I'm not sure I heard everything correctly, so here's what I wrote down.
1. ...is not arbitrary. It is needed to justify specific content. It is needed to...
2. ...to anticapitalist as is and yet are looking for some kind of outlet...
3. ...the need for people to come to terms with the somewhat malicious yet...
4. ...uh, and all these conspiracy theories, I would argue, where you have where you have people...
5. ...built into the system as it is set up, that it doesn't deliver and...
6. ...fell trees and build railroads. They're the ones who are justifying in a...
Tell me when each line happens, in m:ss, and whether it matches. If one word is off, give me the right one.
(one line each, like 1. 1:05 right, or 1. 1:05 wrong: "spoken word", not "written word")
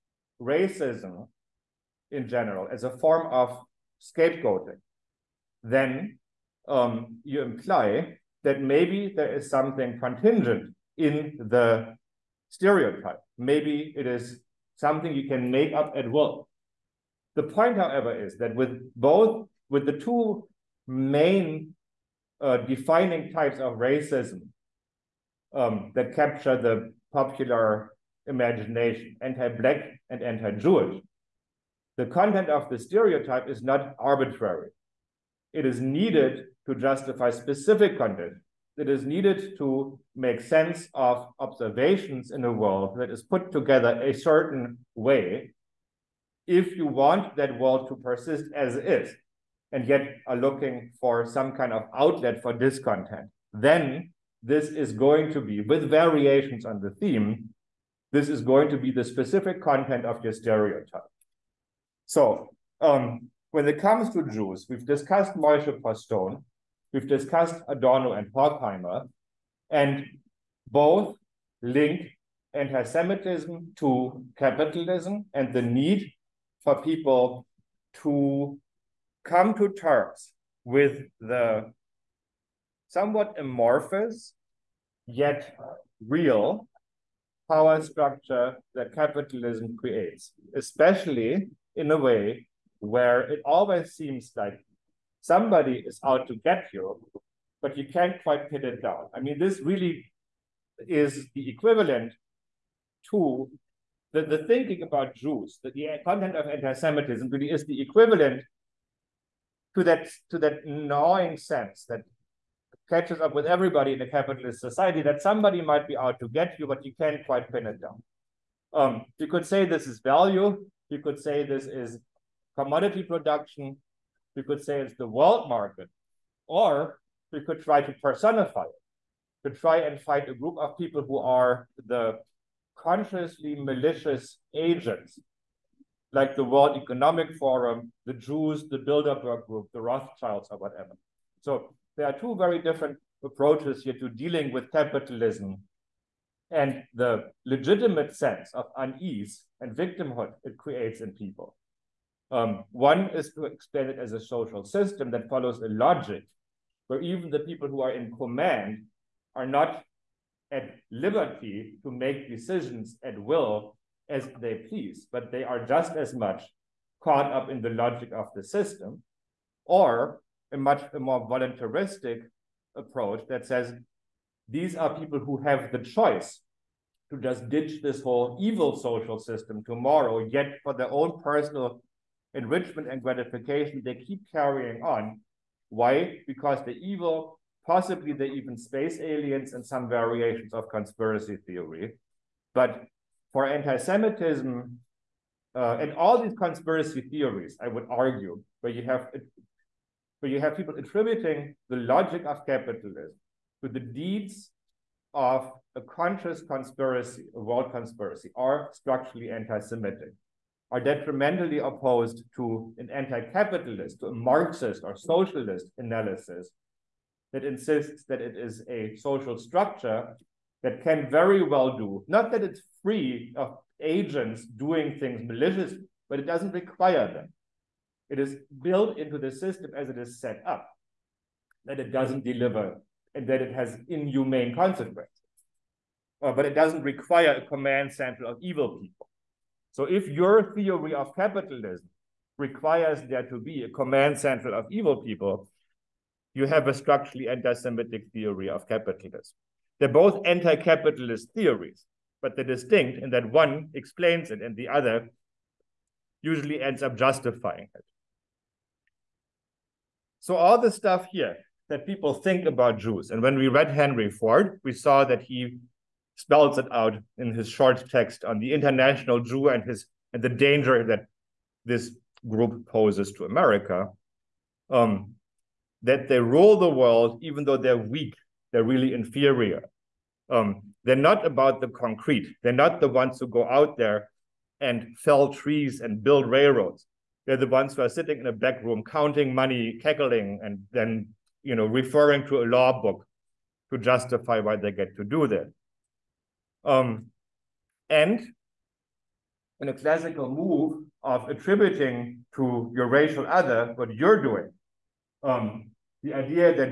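1. 0:33 right
2. 0:47 wrong: "persist", not "anticapitalist"
3. 1:15 wrong: "amorphous", not "malicious"
4. 3:15 right
5. 3:48 right
6. 4:44 wrong: "sitting", not "justifying".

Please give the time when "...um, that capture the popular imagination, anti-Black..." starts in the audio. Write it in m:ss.
0:25.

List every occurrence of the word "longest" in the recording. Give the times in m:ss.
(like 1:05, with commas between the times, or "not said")
not said.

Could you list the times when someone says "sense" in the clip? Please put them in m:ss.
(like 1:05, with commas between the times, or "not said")
0:40, 1:51, 2:28.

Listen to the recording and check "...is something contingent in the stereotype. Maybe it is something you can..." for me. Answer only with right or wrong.
right.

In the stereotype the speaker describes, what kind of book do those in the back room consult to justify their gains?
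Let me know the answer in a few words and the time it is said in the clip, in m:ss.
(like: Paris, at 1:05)
a law book, at 4:52.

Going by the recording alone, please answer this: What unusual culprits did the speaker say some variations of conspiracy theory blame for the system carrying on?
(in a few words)
space aliens.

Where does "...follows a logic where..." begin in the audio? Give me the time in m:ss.
2:35.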